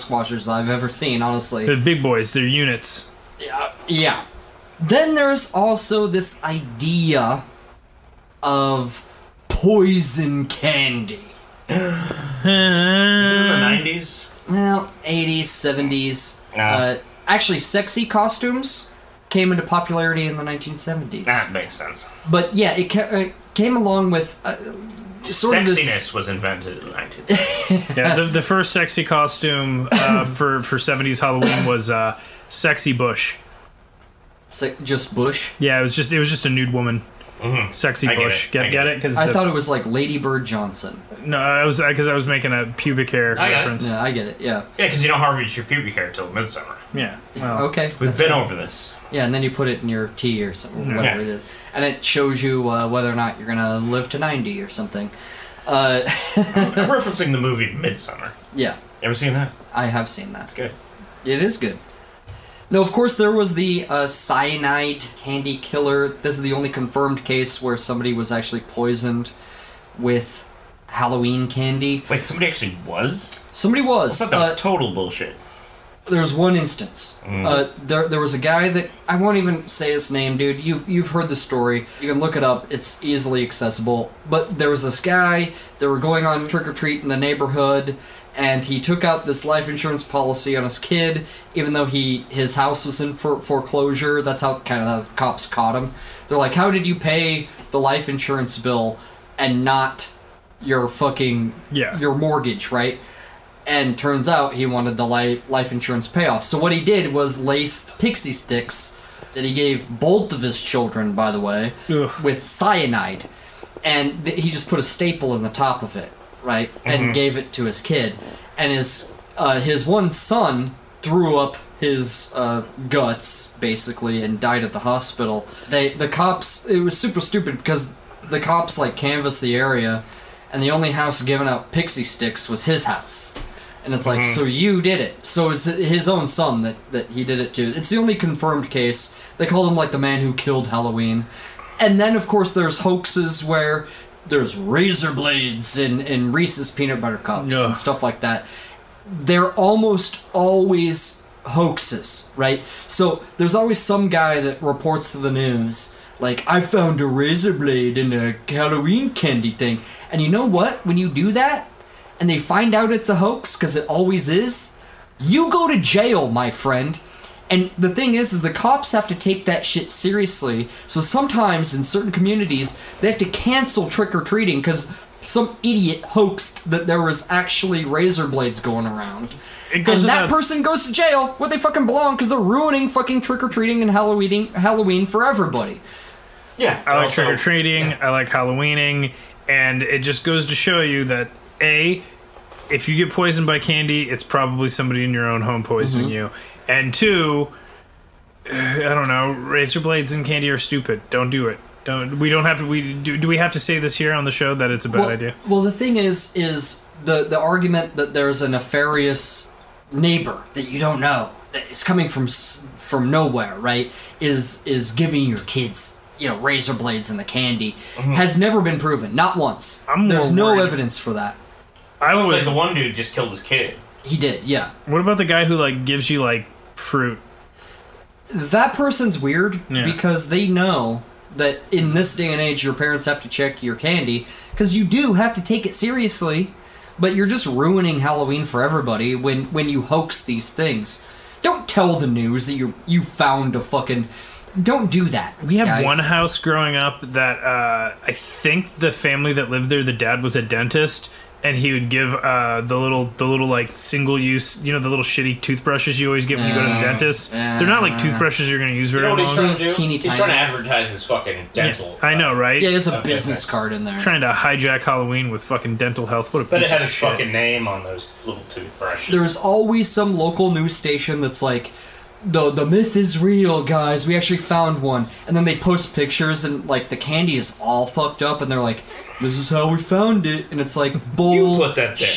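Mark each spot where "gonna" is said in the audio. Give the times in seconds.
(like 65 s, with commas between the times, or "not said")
53 s, 258 s.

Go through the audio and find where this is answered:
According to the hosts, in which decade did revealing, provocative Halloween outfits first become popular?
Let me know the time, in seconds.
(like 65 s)
20 s.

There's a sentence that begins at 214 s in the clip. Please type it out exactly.
Is is giving your kids you know razor blades and the candy mm-hmm.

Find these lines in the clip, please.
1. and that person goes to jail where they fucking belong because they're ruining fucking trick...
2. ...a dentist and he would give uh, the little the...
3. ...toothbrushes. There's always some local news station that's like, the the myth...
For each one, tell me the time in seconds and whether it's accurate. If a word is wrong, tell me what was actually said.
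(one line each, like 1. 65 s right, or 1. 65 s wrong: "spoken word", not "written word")
1. 179 s right
2. 250 s right
3. 268 s right.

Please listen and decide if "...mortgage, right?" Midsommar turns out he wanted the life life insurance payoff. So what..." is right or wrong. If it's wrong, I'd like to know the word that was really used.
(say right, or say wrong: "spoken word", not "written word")
wrong: "And", not "Midsommar".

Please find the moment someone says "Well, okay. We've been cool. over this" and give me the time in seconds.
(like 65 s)
47 s.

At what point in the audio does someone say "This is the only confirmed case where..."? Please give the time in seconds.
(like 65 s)
66 s.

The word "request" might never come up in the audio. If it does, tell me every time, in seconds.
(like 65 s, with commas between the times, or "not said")
not said.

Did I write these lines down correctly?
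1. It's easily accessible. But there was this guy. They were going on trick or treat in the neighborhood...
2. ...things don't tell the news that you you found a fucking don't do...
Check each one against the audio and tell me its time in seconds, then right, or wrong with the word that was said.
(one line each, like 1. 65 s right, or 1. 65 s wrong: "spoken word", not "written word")
1. 82 s right
2. 240 s right.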